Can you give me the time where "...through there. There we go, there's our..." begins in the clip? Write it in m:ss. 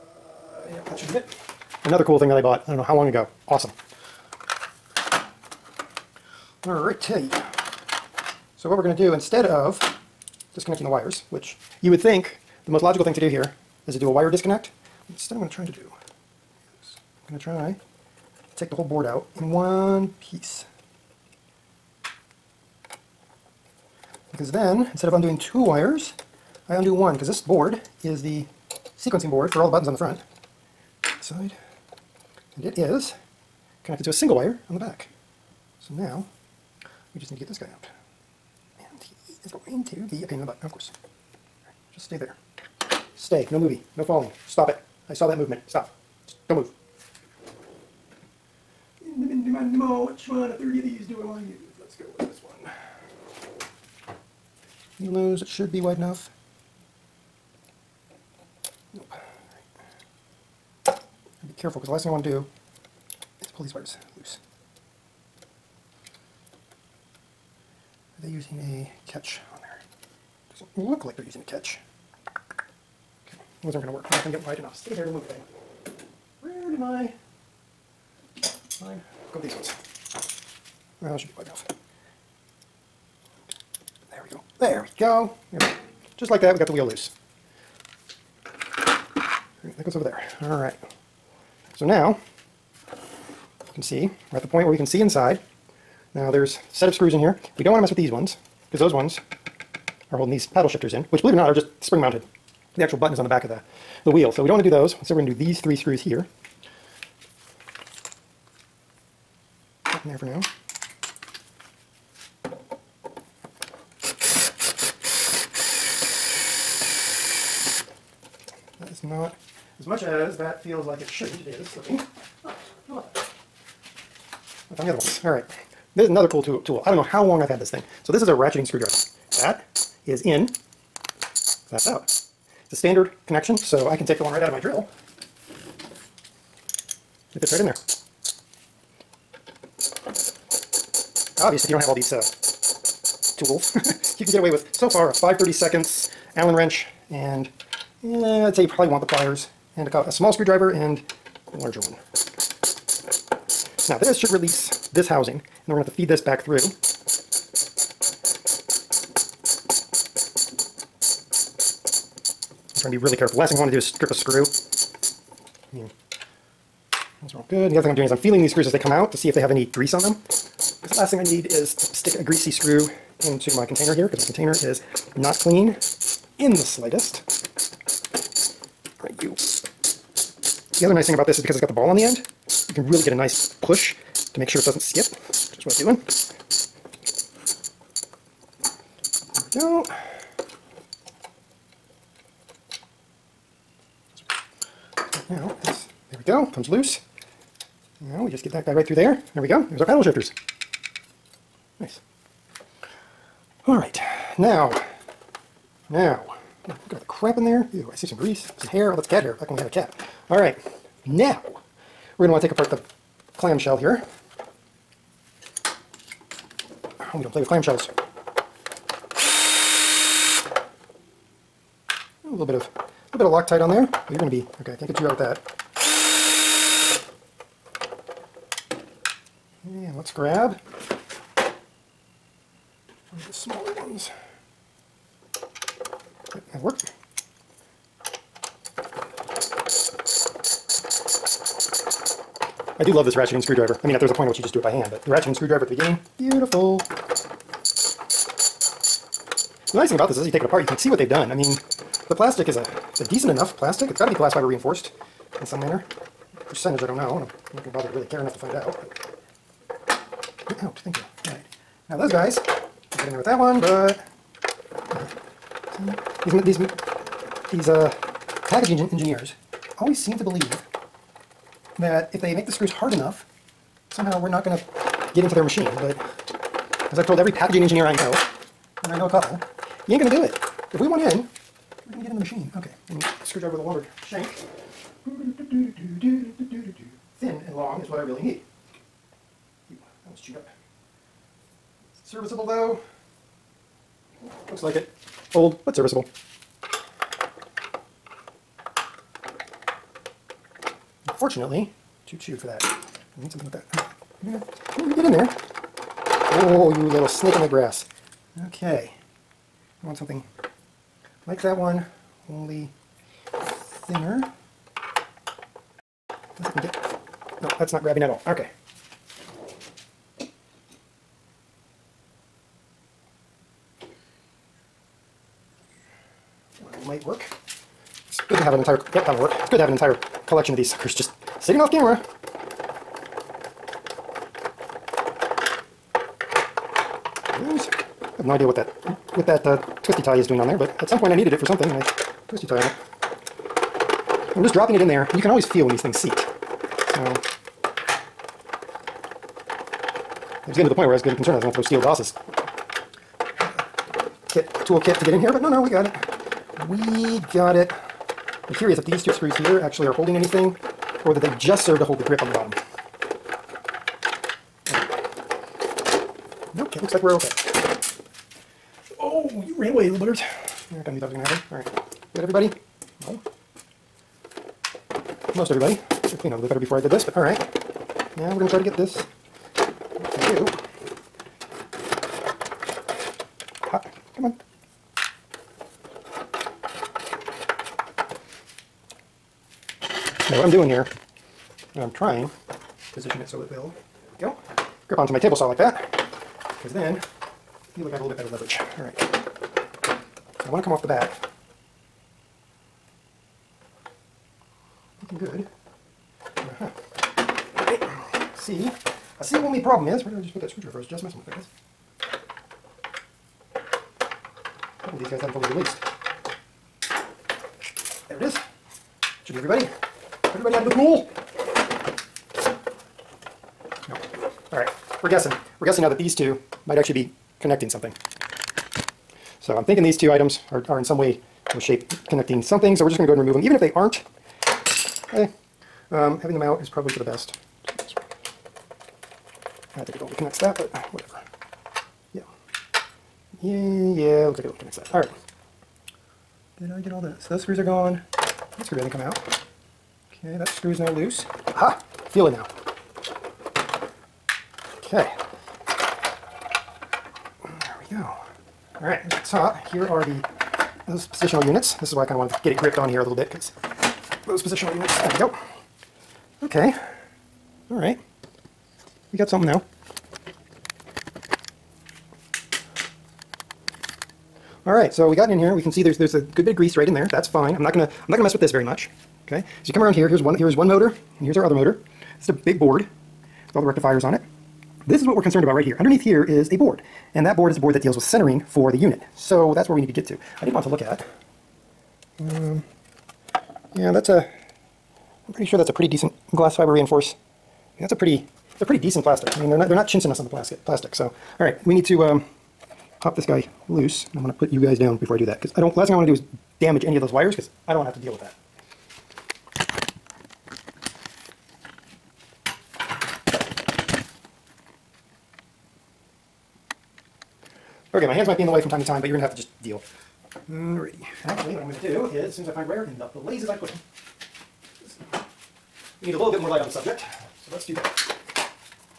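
3:18.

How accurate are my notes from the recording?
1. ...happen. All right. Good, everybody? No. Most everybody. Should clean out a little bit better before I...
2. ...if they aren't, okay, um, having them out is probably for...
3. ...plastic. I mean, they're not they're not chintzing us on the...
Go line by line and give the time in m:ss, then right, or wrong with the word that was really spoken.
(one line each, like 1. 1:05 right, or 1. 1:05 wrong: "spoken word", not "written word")
1. 6:11 right
2. 7:13 right
3. 8:19 right.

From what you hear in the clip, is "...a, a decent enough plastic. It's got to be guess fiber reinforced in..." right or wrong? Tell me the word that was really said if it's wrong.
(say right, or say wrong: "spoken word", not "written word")
wrong: "glass", not "guess".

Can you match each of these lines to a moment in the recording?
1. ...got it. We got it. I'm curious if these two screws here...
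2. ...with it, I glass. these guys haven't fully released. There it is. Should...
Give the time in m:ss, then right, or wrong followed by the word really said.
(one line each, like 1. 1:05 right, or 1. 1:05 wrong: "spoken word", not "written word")
1. 5:55 right
2. 6:51 wrong: "guess", not "glass".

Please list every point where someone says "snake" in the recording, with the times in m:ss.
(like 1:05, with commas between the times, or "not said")
5:07.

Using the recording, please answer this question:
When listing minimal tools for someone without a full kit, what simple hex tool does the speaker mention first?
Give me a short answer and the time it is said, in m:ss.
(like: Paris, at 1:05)
Allen wrench, at 2:26.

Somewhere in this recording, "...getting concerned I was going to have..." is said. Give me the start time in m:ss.
5:51.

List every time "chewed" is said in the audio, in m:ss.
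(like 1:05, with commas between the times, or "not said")
4:50, 5:02.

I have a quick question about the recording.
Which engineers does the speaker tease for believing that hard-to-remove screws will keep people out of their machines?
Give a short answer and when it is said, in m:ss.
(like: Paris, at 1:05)
packaging engineers, at 4:28.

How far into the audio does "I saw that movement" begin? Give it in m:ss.
0:45.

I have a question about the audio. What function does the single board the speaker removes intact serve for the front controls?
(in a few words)
sequencing board.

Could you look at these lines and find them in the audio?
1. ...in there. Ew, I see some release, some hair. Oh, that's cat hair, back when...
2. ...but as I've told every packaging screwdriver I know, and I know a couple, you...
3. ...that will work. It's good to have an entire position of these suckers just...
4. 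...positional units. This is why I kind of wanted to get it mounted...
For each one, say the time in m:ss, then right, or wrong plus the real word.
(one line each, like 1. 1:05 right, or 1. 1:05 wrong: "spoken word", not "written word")
1. 3:27 wrong: "grease", not "release"
2. 4:35 wrong: "engineer", not "screwdriver"
3. 5:29 wrong: "collection", not "position"
4. 7:41 wrong: "gripped", not "mounted".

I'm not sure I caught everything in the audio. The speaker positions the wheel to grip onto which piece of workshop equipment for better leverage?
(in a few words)
table saw.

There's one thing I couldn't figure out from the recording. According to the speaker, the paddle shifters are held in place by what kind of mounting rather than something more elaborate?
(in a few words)
spring mounted.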